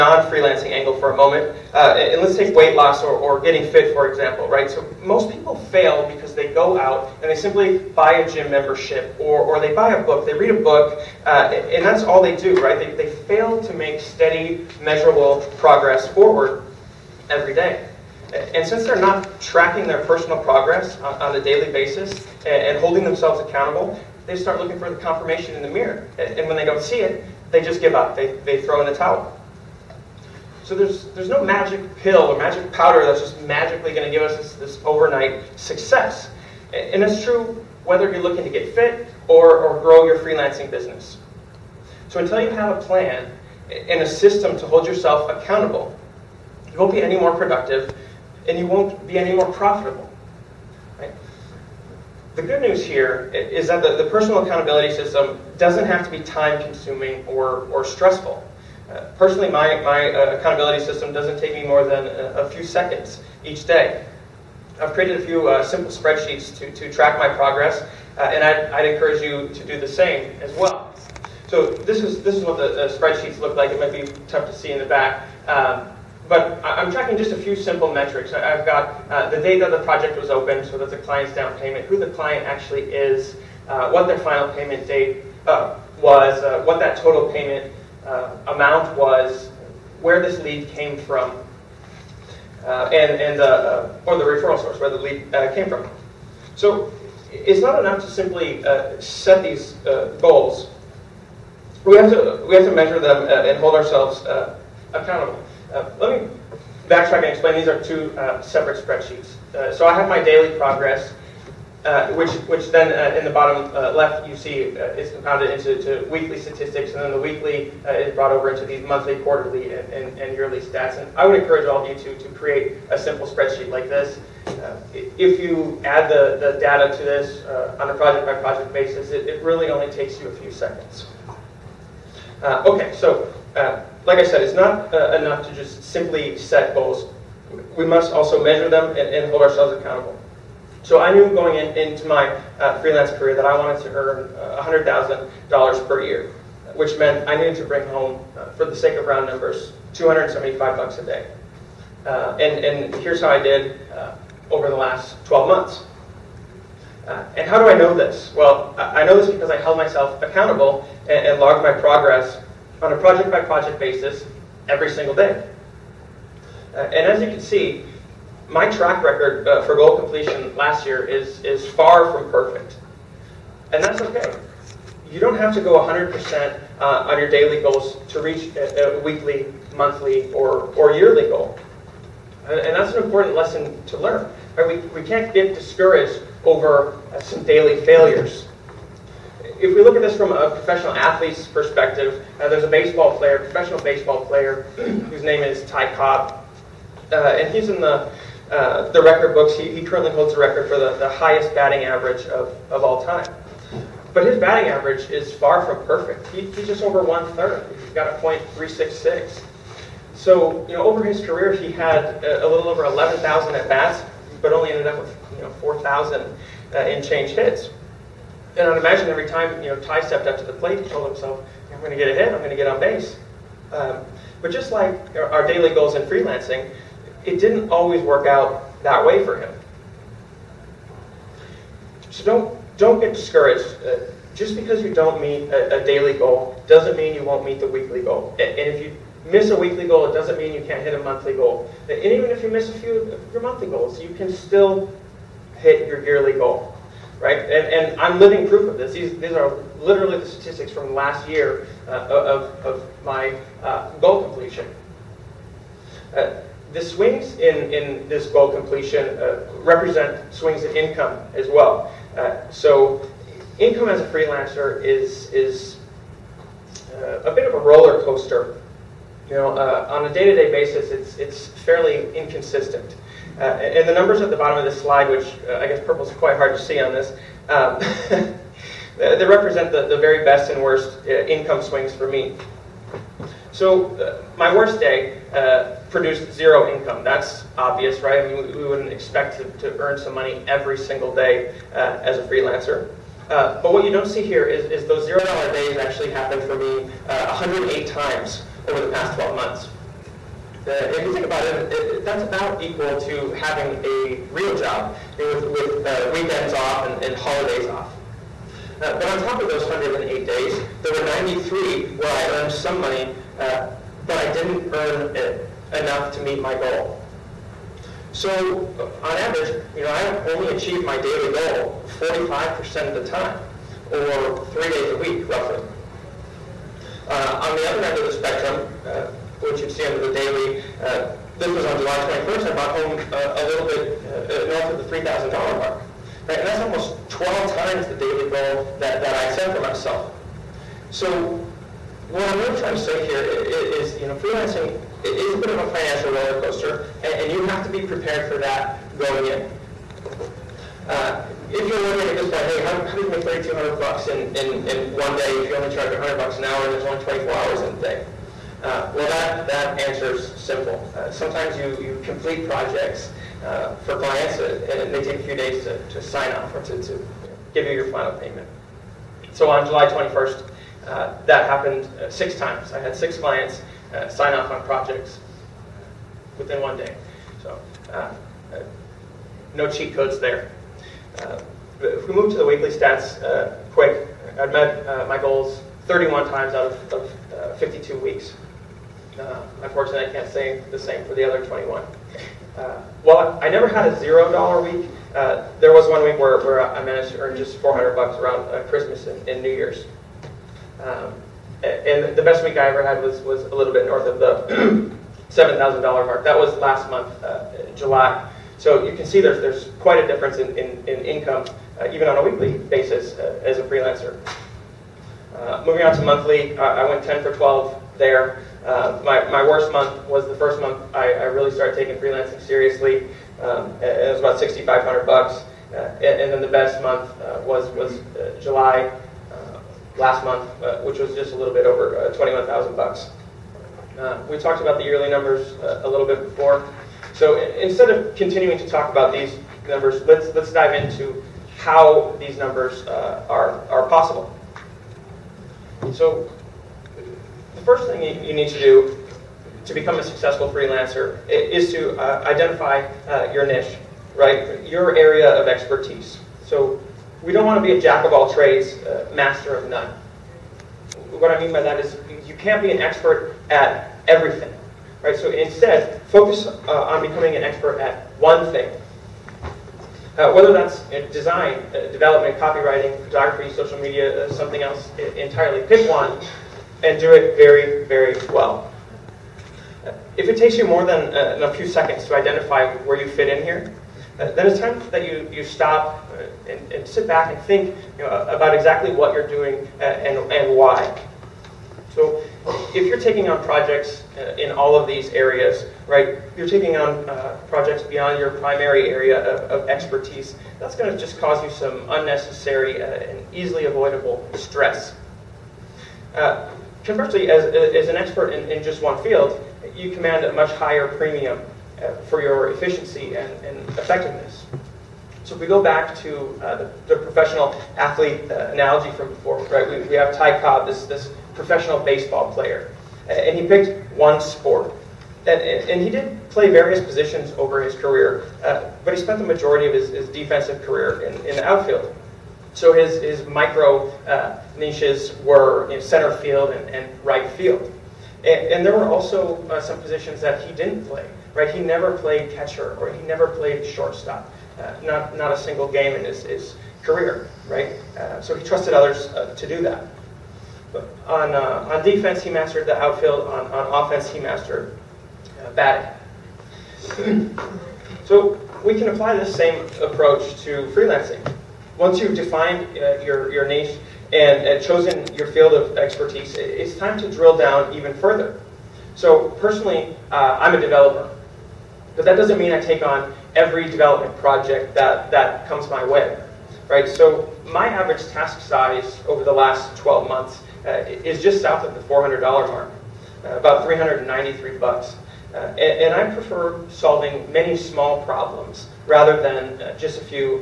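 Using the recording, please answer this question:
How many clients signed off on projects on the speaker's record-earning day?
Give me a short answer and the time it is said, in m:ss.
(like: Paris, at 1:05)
6, at 6:12.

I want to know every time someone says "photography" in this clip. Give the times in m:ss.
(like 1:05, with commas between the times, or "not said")
7:53.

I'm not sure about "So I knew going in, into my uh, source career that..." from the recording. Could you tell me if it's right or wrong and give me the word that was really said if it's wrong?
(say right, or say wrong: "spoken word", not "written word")
wrong: "freelance", not "source".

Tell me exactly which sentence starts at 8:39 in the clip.
We, we, have Ty Cobb, this, this professional baseball player.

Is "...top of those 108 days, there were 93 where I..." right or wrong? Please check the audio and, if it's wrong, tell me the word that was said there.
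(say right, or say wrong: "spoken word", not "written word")
right.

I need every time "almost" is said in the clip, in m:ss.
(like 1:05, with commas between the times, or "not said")
5:36.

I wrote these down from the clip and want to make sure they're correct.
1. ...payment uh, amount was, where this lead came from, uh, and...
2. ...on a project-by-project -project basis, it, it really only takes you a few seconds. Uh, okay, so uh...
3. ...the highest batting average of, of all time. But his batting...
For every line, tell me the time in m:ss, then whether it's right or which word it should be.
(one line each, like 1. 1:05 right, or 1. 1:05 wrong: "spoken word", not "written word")
1. 1:27 right
2. 2:07 right
3. 3:20 right.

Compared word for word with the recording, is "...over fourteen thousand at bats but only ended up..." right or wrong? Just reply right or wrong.
wrong.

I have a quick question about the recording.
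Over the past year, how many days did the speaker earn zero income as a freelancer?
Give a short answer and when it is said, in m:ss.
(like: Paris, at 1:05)
108, at 4:57.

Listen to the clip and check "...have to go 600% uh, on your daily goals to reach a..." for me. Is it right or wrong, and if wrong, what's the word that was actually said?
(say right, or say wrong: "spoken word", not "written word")
wrong: "100", not "600".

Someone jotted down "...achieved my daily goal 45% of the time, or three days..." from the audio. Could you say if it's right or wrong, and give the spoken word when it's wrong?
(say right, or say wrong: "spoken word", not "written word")
right.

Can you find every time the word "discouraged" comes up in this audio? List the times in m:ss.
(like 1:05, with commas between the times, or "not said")
3:05, 3:53.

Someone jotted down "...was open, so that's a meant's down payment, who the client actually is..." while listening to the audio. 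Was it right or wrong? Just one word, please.
wrong.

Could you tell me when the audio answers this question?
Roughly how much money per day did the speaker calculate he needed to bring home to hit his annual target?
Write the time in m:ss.
2:29.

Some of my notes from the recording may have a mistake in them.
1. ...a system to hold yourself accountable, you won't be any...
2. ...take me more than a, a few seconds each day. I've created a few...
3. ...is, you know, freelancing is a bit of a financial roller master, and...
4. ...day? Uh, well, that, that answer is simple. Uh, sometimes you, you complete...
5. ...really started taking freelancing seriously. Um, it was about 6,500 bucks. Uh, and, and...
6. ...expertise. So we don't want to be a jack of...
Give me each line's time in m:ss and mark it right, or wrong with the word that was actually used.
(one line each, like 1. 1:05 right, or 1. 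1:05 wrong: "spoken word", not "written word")
1. 0:44 right
2. 1:01 right
3. 5:43 wrong: "coaster", not "master"
4. 5:57 right
5. 7:01 right
6. 7:35 right.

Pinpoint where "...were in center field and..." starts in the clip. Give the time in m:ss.
8:55.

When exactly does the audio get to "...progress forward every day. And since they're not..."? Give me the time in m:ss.
0:15.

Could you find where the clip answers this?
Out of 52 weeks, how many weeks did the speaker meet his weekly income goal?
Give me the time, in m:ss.
6:25.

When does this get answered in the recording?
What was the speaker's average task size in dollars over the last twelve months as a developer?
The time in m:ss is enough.
9:43.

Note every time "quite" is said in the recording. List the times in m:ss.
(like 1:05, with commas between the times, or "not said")
4:36, 6:49.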